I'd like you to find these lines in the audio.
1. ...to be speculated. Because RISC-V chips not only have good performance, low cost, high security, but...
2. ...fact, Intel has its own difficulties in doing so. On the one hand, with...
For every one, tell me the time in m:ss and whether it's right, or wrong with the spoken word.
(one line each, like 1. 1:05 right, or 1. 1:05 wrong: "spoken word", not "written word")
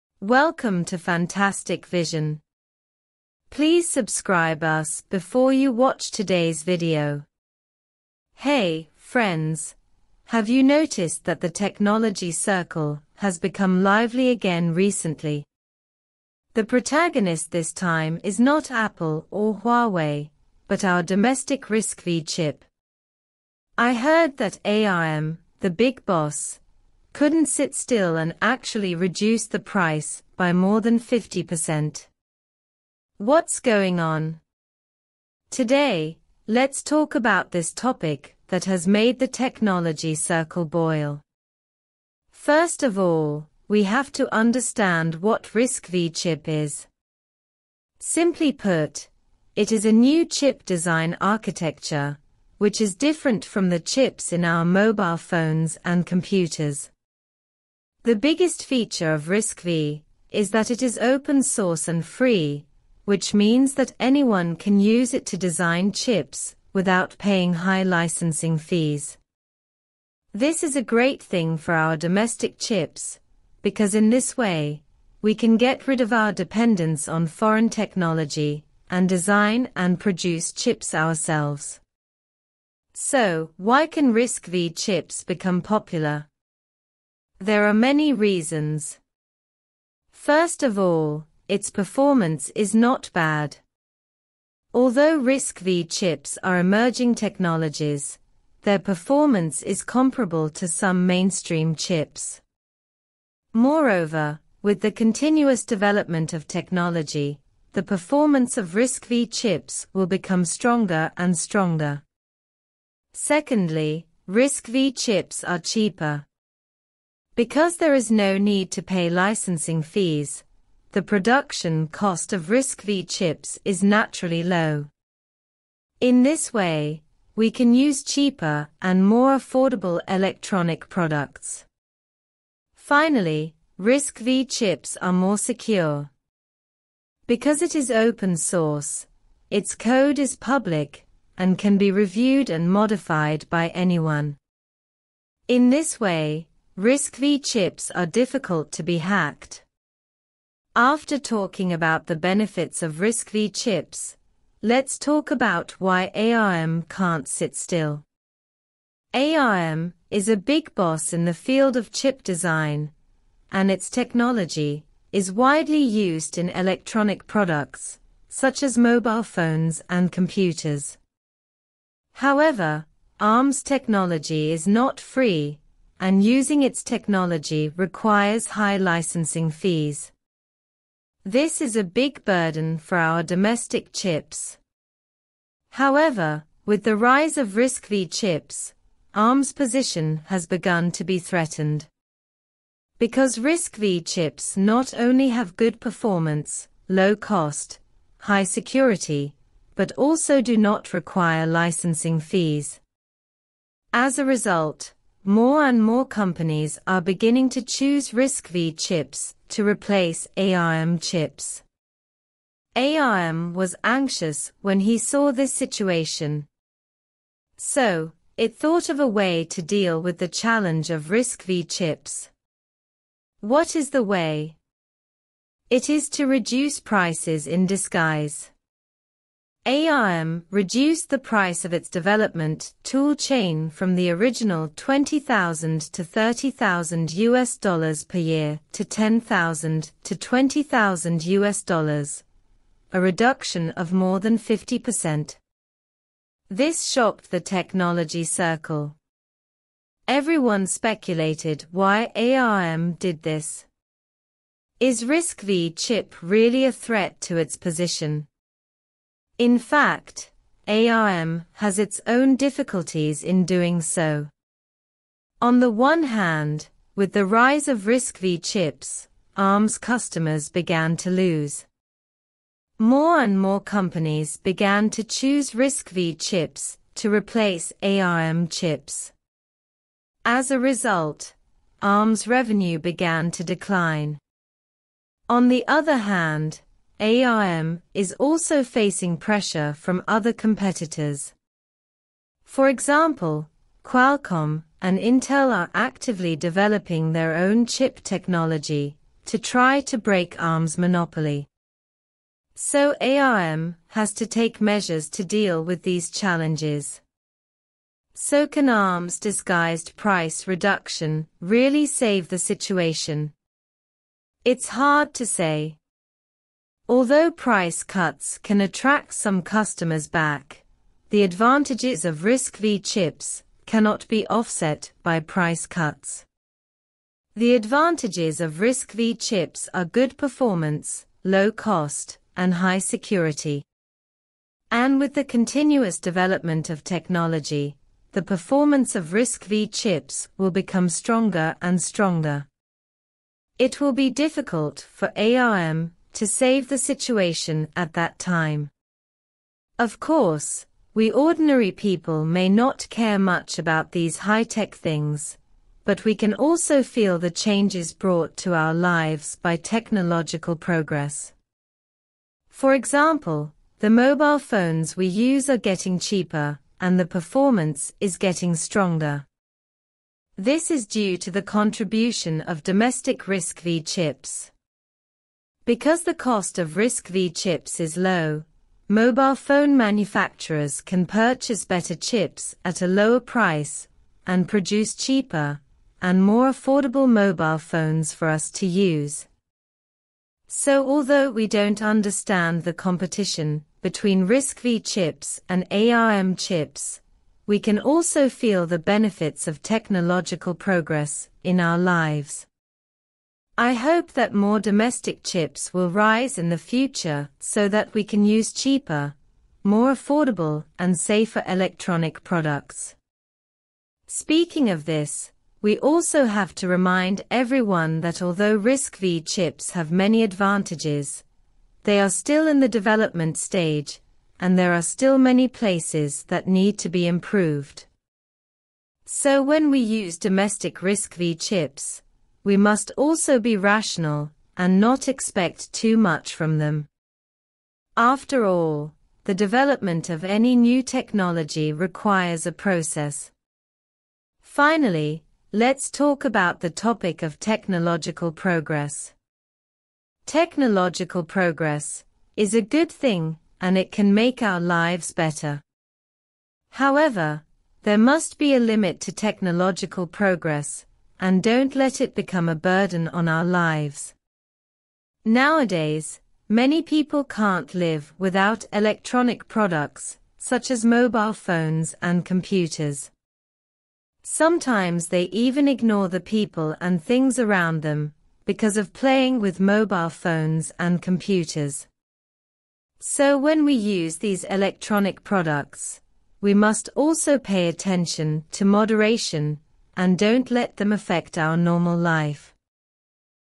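1. 3:10 wrong: "threatened", not "speculated"
2. 4:19 wrong: "ARM", not "Intel".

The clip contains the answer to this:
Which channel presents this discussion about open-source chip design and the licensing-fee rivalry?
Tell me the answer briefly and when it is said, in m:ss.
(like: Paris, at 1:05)
Fantastic Vision, at 0:00.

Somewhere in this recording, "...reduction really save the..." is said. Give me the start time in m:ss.
5:10.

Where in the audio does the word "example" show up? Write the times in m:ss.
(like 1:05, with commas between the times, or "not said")
4:52, 6:02.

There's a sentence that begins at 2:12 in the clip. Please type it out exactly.
Finally, RISC-V chips are more secure.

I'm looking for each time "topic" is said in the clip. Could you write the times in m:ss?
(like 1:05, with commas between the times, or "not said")
0:37, 7:26.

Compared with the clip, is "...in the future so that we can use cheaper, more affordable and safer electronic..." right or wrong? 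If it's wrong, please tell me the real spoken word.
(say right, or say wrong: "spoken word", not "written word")
right.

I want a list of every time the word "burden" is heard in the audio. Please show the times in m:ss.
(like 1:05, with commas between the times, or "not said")
3:02, 7:42.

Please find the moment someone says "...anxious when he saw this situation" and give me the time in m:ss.
3:33.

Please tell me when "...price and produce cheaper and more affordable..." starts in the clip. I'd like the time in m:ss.
6:23.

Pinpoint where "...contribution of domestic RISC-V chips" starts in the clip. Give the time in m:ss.
6:11.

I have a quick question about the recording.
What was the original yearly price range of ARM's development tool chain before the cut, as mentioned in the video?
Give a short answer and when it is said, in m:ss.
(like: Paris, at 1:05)
$20,000 to $30,000, at 3:54.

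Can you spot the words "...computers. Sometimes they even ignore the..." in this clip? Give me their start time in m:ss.
7:52.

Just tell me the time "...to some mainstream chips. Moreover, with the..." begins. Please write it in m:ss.
1:40.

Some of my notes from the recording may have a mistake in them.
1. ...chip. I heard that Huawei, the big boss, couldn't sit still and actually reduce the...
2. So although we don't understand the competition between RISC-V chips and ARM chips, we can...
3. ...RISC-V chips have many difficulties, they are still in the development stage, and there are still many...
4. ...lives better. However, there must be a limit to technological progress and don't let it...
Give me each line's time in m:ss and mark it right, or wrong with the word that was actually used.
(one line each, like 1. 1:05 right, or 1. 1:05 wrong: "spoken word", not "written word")
1. 0:22 wrong: "ARM", not "Huawei"
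2. 6:30 right
3. 6:58 wrong: "advantages", not "difficulties"
4. 7:34 right.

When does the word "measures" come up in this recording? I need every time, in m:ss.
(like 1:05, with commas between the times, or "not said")
5:04.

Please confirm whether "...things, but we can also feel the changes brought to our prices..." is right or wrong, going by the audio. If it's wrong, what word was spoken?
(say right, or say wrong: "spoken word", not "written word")
wrong: "lives", not "prices".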